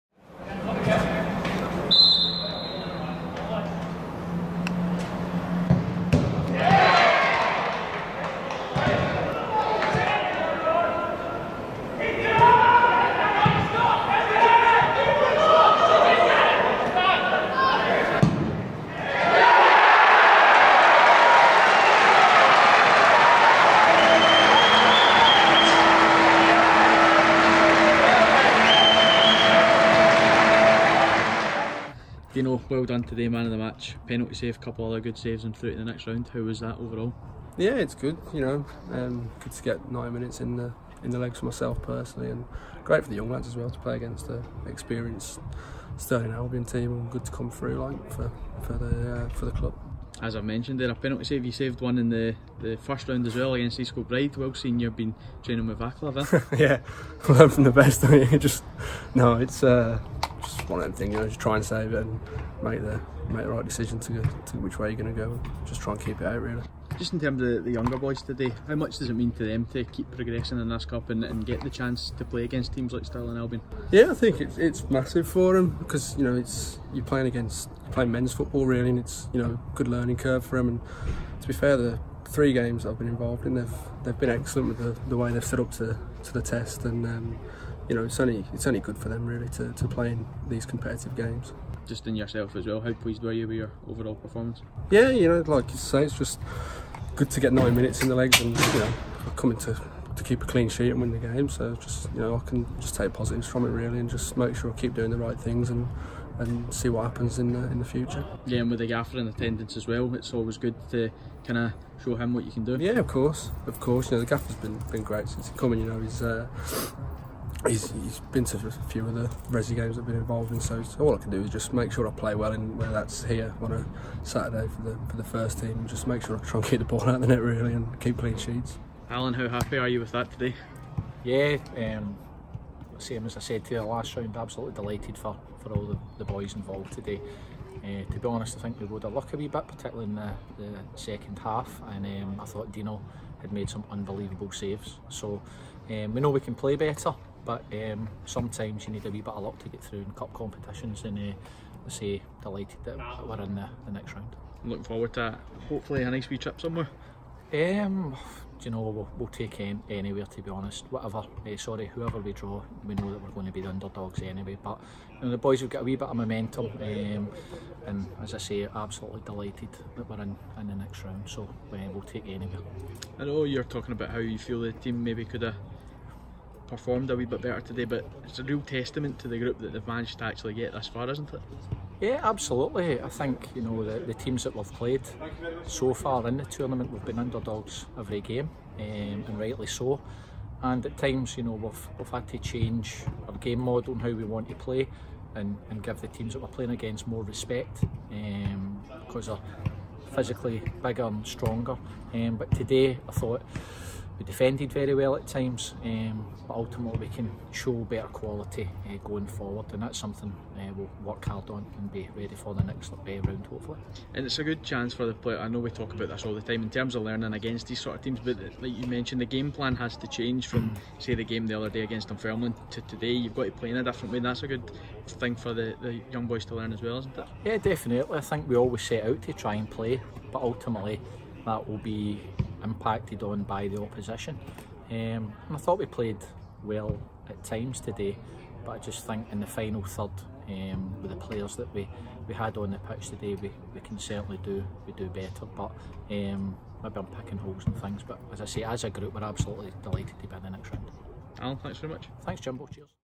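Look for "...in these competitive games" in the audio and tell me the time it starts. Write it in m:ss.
1:30.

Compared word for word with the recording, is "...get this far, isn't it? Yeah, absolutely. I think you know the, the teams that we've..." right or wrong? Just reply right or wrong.
right.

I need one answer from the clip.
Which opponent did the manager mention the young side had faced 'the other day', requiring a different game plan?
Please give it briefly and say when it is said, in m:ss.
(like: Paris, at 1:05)
Dunfermline, at 3:42.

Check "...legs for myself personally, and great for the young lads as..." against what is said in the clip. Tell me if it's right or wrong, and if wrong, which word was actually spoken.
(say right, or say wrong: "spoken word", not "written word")
right.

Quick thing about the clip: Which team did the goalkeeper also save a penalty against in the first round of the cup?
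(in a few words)
East Kilbride.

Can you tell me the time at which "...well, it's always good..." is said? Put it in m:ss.
1:49.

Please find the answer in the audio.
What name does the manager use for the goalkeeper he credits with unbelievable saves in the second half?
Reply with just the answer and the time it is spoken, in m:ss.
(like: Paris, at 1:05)
Dino, at 2:22.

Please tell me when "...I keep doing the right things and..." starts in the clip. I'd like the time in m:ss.
1:44.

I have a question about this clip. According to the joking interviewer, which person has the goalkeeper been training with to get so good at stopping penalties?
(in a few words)
Vaclav.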